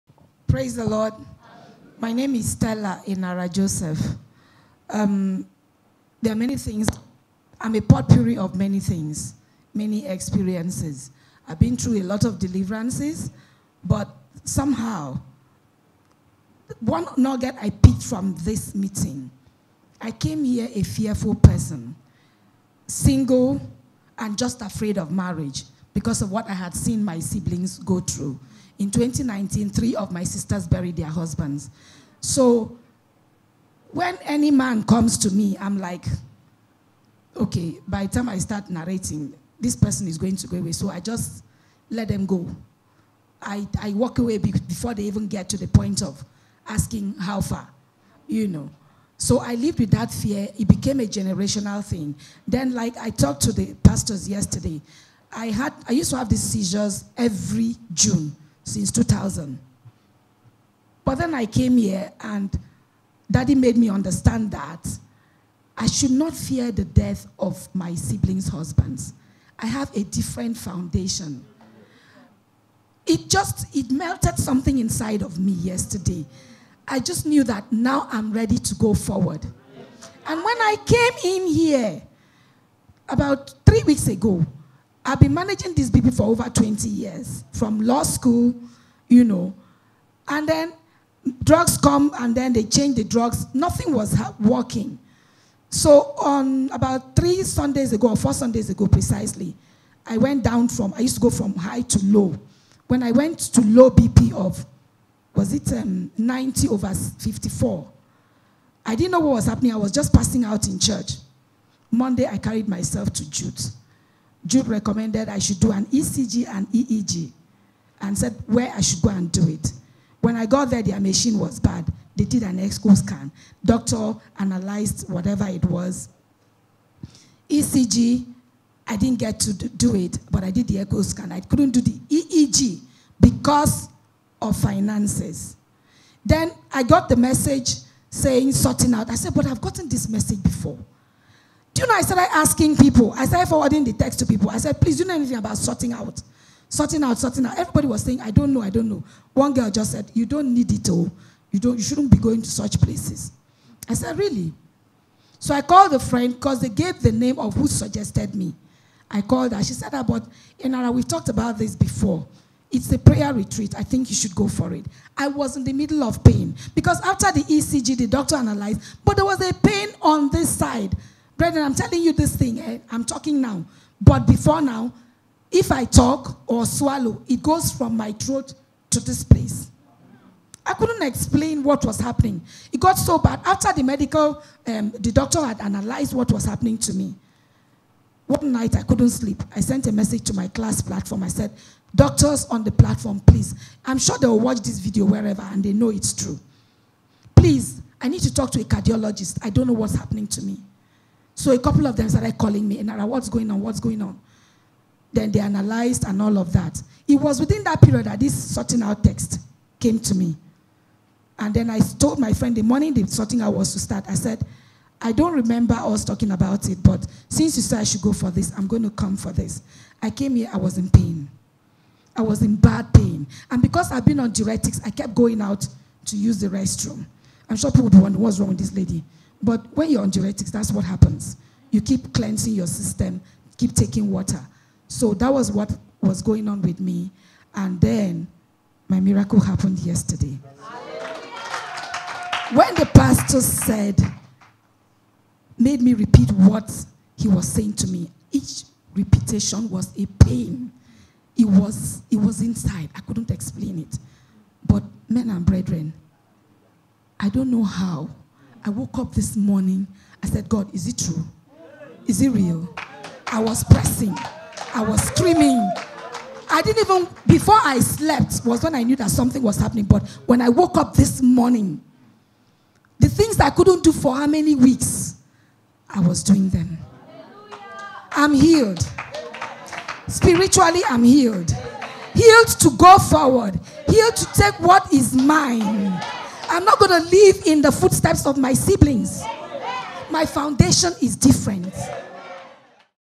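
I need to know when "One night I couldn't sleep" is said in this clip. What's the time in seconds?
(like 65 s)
188 s.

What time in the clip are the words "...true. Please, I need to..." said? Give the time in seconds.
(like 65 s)
196 s.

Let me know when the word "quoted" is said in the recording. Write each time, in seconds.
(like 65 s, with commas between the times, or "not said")
not said.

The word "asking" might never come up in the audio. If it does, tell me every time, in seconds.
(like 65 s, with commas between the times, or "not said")
46 s, 142 s.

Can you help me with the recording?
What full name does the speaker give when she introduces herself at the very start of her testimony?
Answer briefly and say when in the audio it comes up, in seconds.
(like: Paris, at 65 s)
Stella Inara Joseph, at 2 s.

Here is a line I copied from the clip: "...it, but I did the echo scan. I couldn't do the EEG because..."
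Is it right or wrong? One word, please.
right.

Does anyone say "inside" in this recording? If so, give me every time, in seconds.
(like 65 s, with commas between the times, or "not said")
74 s, 252 s.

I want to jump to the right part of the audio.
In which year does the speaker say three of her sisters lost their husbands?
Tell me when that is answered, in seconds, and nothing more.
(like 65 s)
28 s.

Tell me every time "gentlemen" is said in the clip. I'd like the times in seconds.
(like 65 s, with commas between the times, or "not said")
not said.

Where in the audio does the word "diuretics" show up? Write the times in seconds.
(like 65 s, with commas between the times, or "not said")
224 s, 230 s.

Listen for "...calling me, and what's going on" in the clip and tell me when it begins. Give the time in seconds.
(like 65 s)
202 s.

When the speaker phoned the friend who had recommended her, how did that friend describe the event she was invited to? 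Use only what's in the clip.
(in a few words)
a prayer retreat.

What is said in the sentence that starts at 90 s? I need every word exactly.
And then drugs come and then they change the drugs.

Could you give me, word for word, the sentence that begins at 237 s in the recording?
And then my miracle happened yesterday.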